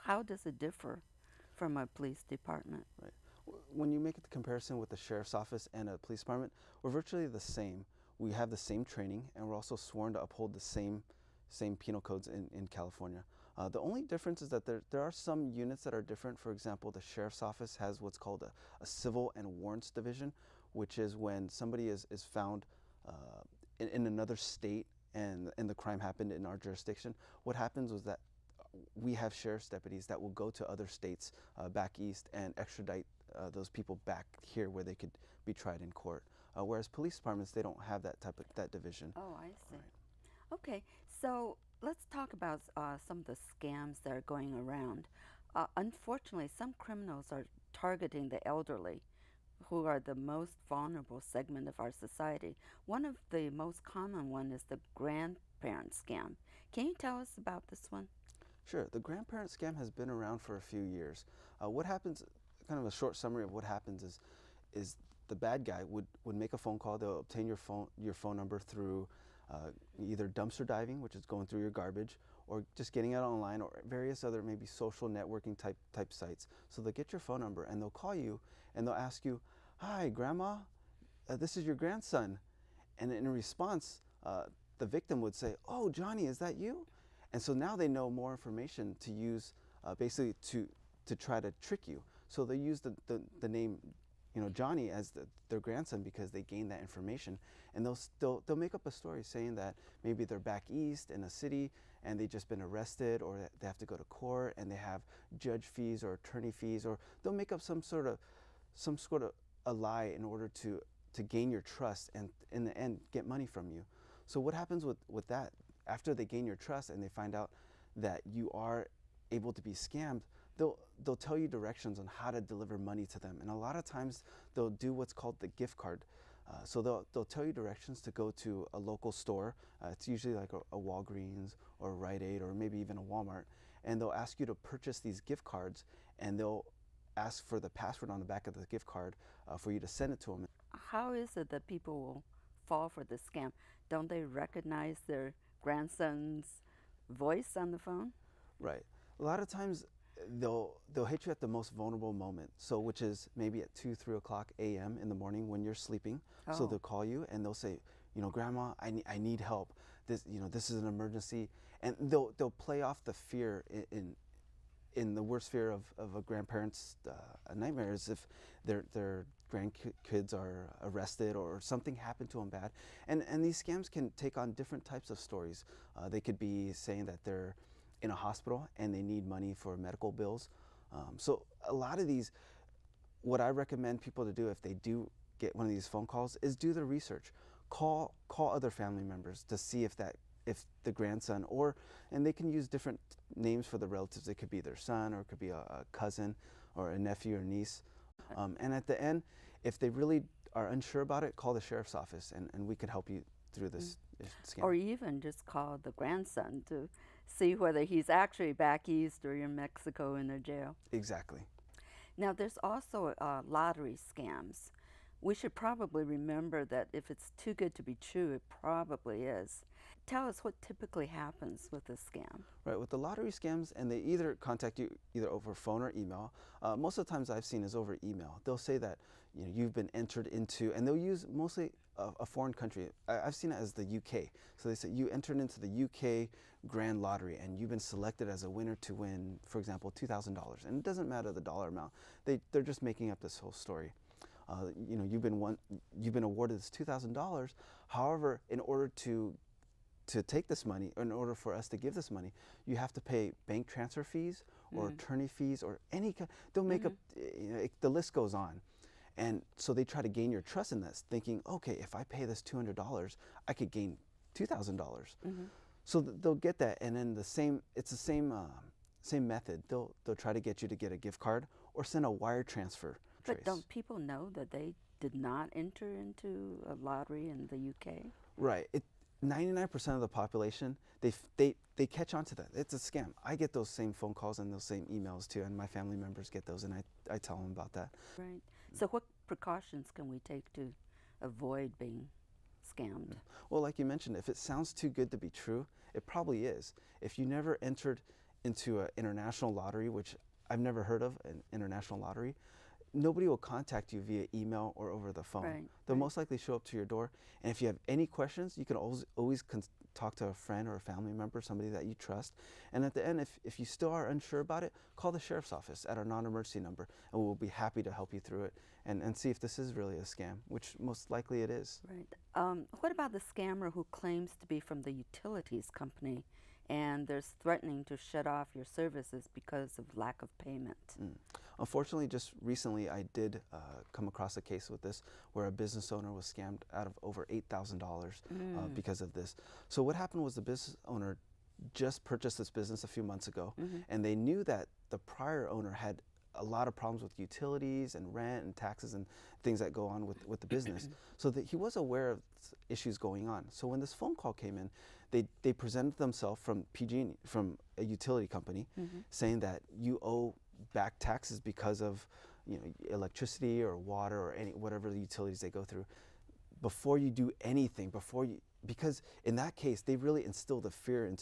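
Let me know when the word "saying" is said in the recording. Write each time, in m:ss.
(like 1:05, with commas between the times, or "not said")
1:39, 2:56, 5:59.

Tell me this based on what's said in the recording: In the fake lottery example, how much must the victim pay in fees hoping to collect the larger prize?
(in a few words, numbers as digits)
$200.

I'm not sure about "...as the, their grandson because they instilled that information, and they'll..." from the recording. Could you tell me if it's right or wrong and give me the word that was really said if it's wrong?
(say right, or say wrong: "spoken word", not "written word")
wrong: "gained", not "instilled".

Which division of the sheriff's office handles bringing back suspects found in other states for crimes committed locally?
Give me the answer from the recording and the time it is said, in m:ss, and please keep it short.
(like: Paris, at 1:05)
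civil and warrants division, at 0:18.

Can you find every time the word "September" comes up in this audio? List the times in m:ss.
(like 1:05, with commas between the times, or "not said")
not said.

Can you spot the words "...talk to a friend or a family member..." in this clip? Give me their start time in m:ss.
5:09.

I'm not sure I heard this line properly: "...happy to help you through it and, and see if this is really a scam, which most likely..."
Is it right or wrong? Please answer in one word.
right.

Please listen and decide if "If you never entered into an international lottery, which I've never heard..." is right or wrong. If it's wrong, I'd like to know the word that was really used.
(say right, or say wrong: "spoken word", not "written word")
right.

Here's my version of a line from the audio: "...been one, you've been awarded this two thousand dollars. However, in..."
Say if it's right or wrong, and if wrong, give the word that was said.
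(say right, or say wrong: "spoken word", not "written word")
right.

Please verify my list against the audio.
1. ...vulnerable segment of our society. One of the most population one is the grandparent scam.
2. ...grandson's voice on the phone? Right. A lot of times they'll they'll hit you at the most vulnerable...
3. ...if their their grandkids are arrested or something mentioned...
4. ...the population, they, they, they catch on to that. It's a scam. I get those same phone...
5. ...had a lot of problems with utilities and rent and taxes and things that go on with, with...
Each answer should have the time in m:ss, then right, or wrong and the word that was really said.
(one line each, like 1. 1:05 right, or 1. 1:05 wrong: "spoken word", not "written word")
1. 0:50 wrong: "common", not "population"
2. 2:25 right
3. 2:48 wrong: "happened", not "mentioned"
4. 4:40 right
5. 5:45 right.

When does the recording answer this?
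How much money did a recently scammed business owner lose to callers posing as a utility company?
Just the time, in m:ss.
5:37.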